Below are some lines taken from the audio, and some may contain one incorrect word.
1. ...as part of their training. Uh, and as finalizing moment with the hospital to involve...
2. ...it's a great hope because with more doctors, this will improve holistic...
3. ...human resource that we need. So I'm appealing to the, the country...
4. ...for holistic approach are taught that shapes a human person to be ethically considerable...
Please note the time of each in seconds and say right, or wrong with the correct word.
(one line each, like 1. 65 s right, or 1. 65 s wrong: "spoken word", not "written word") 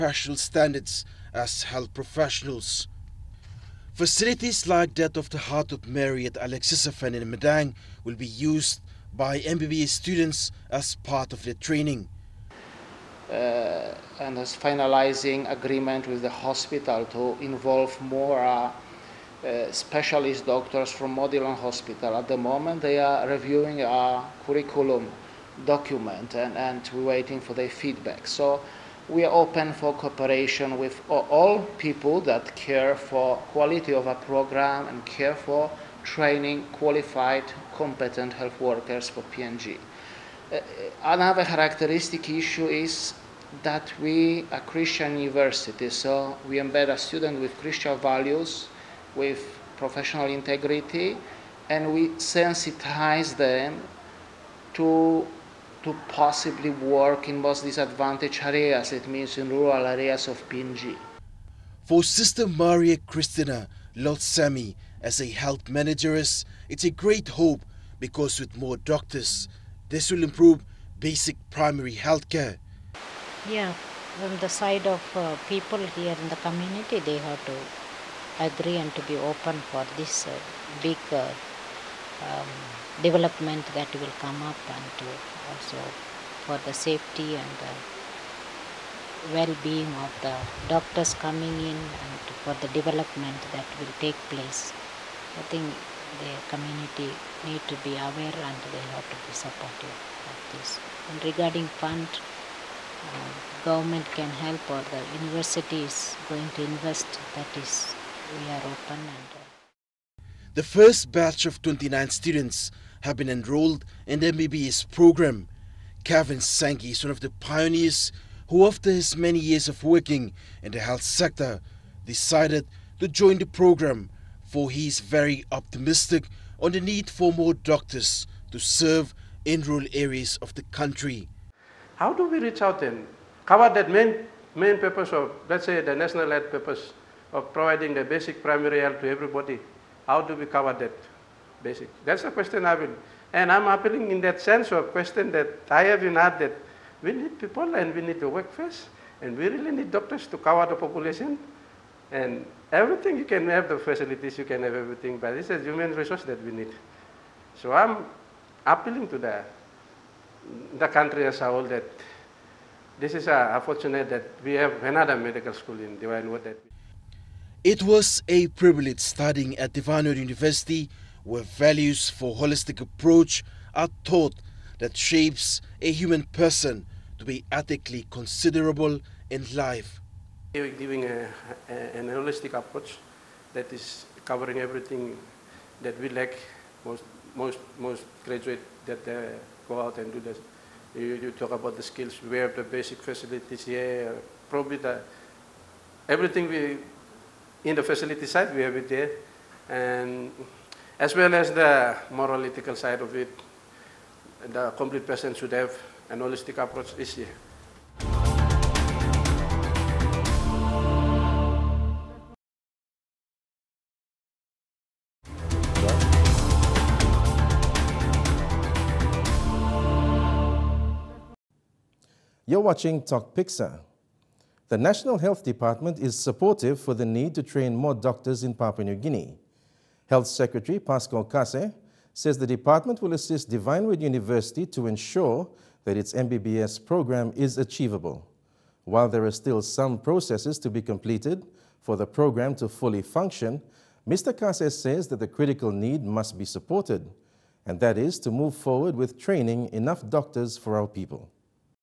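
1. 10 s wrong: "agreement", not "moment"
2. 66 s wrong: "basic", not "holistic"
3. 155 s right
4. 172 s right.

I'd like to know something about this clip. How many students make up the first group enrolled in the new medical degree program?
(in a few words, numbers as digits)
29.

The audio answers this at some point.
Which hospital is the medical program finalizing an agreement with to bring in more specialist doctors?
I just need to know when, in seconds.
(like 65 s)
21 s.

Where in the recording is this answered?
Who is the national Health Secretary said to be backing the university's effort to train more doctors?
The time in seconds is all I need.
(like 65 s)
230 s.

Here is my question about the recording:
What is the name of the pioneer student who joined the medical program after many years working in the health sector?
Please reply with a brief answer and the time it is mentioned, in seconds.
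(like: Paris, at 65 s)
Kevin Sankey, at 116 s.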